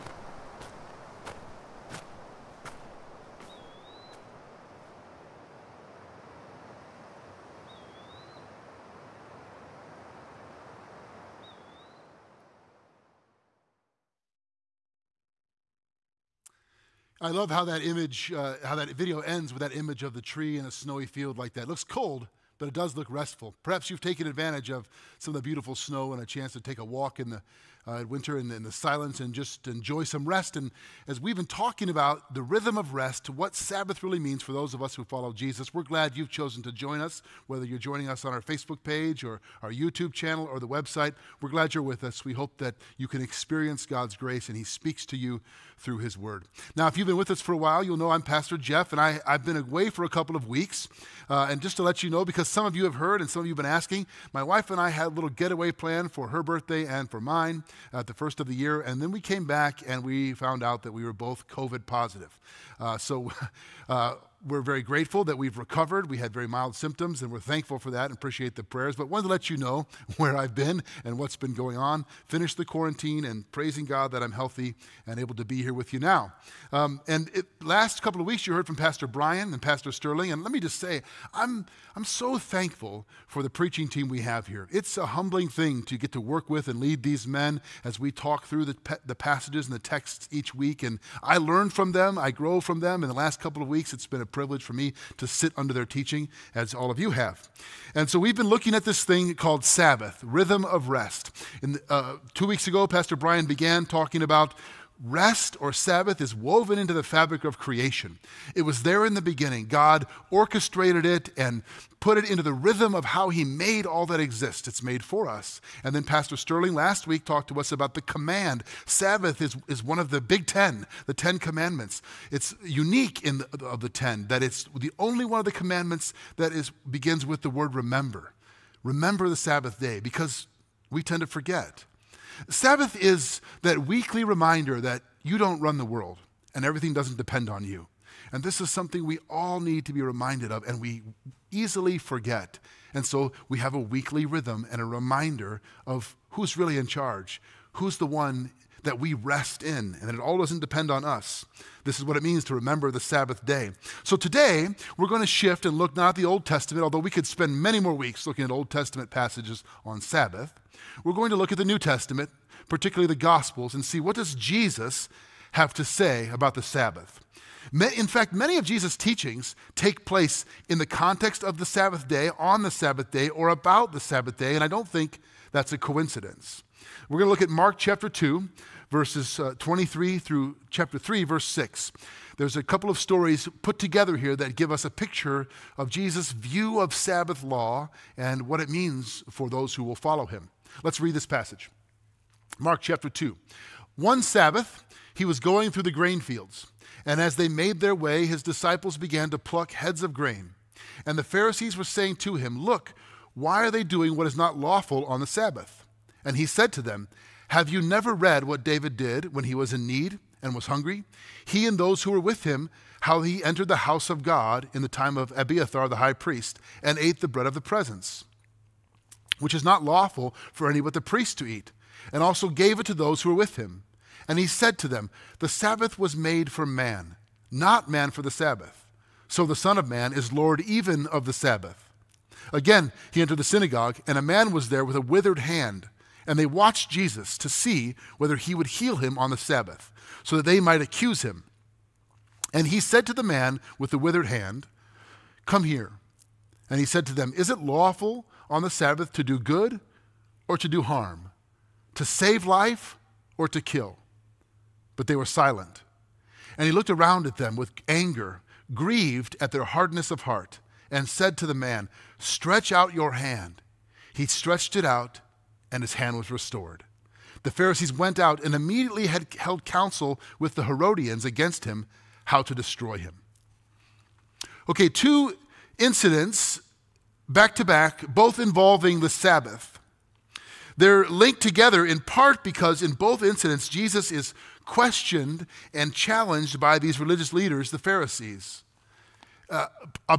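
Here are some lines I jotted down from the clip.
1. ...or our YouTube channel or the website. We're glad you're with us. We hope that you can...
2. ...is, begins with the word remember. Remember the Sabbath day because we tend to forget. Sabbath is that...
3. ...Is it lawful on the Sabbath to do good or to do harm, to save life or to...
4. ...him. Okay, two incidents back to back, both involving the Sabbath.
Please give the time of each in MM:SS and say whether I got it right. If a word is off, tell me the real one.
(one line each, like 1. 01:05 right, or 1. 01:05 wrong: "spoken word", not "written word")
1. 00:39 right
2. 02:06 right
3. 04:07 right
4. 04:32 right.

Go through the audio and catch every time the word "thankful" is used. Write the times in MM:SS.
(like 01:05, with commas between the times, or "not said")
01:07, 01:22.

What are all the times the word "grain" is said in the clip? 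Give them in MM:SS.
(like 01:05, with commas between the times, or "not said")
03:15, 03:20.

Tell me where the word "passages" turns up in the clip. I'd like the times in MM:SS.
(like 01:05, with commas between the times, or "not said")
01:29, 02:39, 03:11.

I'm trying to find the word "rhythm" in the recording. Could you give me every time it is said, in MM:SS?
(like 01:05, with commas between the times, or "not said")
00:32, 01:40, 01:52, 02:24.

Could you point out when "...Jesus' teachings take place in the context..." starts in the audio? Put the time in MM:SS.
02:48.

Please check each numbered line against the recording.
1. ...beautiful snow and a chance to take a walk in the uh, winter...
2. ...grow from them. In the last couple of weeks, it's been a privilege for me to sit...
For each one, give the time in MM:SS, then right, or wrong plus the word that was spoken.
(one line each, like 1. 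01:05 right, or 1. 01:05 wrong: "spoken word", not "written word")
1. 00:25 right
2. 01:32 right.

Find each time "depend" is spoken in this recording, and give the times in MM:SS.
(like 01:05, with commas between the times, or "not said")
02:17, 02:30.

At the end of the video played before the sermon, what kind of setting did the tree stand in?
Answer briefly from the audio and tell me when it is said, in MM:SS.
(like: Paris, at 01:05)
a snowy field, at 00:20.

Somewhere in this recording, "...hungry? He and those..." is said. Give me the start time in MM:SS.
03:30.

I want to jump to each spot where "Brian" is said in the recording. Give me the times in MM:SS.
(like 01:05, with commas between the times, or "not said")
01:19, 01:43.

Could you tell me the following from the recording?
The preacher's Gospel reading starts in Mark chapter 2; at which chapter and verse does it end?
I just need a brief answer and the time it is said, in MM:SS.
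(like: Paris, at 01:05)
Chapter 3, verse 6, at 03:00.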